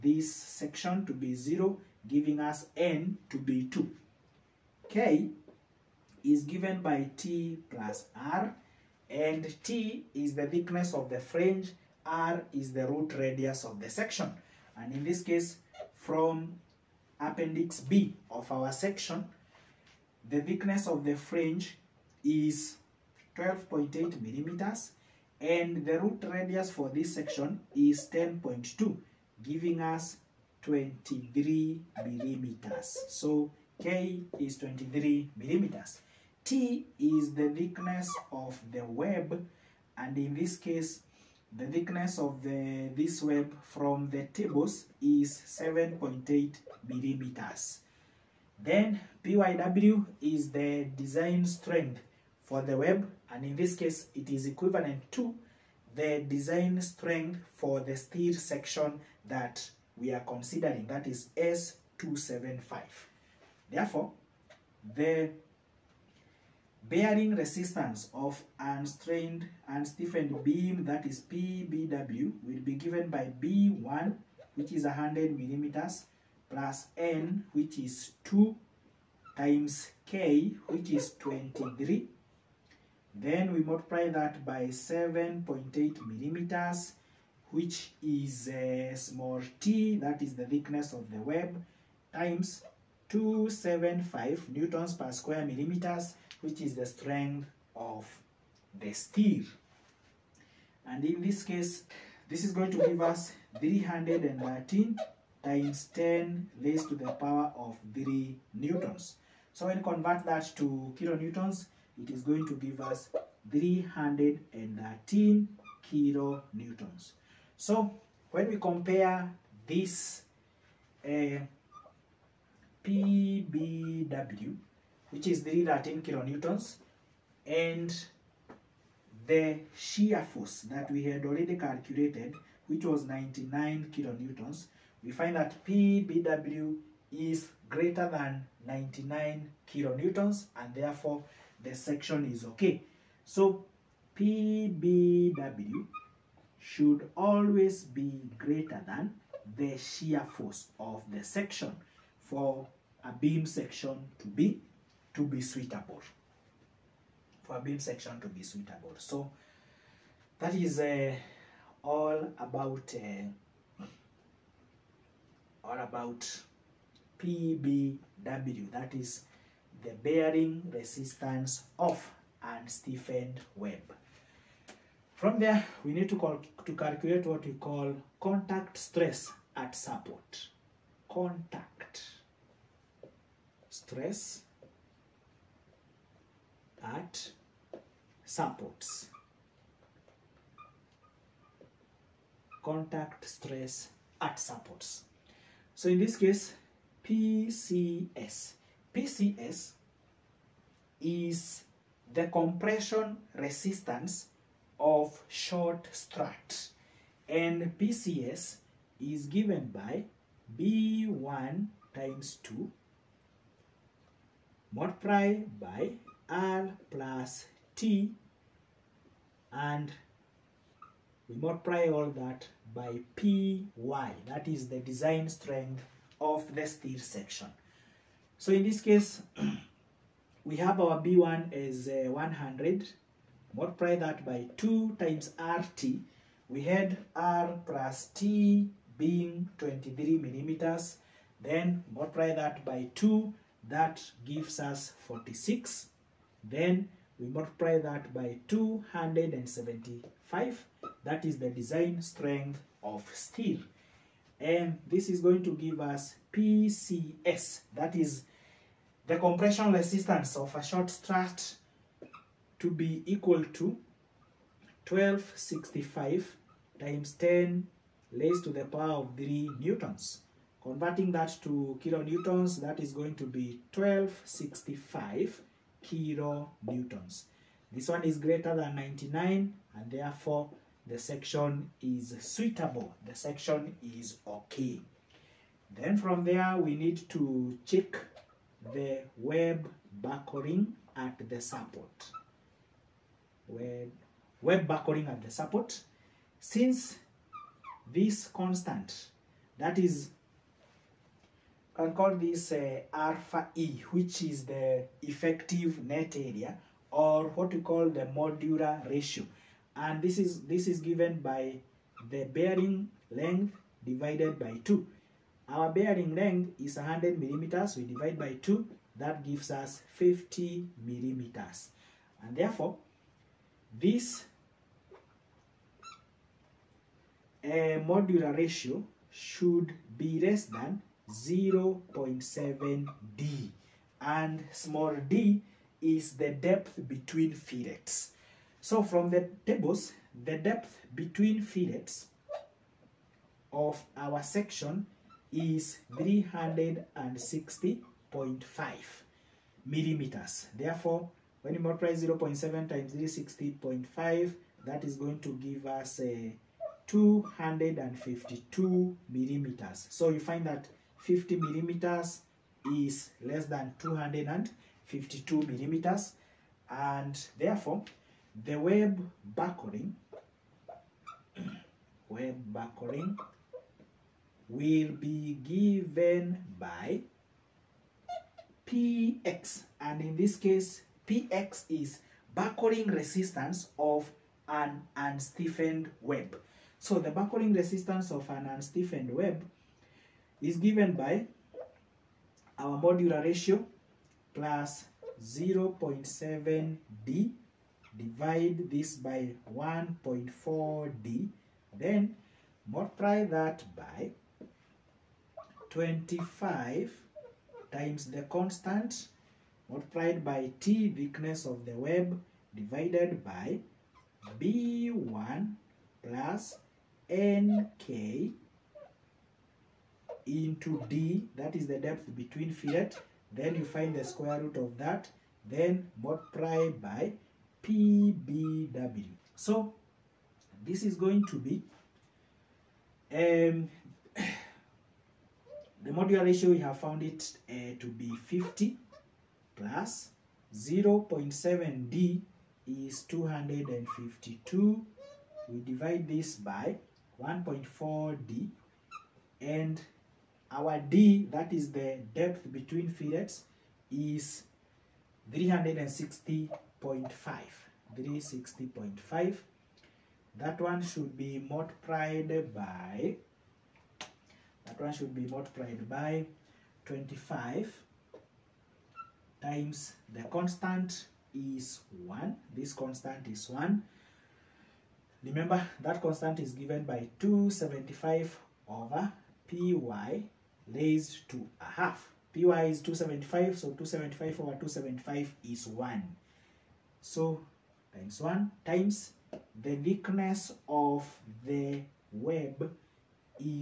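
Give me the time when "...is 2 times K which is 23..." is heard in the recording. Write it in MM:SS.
01:17.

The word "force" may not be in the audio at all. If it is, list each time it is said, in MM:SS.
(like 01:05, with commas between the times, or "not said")
02:10, 02:30.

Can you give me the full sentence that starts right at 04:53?
Web, web buckling at the support.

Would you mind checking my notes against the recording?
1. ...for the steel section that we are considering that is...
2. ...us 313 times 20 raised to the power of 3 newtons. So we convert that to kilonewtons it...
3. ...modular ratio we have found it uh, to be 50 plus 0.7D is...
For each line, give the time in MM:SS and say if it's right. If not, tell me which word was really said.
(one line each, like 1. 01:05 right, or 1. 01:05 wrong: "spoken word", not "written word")
1. 00:57 right
2. 01:43 wrong: "10", not "20"
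3. 07:15 right.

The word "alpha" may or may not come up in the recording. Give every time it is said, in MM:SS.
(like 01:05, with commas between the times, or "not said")
05:02.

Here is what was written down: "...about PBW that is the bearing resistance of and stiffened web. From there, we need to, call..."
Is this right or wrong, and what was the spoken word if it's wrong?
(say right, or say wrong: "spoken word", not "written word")
right.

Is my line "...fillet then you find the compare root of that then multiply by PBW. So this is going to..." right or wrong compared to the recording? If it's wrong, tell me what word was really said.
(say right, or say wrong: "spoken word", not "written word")
wrong: "square", not "compare".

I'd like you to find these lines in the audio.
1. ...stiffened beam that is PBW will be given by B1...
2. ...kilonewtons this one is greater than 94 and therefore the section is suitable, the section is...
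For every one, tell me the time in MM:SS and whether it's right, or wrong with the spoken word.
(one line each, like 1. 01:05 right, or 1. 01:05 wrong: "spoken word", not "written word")
1. 01:09 right
2. 04:35 wrong: "99", not "94".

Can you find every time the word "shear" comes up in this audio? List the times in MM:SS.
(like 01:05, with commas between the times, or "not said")
02:09, 02:29.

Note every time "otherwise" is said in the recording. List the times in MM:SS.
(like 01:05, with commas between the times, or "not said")
not said.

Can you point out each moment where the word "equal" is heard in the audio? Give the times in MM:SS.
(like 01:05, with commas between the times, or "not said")
04:23.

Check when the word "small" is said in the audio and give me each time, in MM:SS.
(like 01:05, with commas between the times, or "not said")
01:28, 05:34.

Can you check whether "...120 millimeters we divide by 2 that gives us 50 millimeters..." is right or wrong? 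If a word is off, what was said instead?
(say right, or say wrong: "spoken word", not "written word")
wrong: "100", not "120".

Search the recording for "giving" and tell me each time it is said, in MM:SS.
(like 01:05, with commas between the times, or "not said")
00:02, 00:29.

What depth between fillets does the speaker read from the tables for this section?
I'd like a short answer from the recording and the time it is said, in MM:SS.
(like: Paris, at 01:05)
360.5 mm, at 05:45.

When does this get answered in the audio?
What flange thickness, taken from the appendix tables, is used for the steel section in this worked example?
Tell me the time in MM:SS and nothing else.
00:23.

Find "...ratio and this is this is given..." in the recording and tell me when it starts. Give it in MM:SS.
05:08.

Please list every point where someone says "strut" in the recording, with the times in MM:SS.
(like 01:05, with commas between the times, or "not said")
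03:25, 04:20.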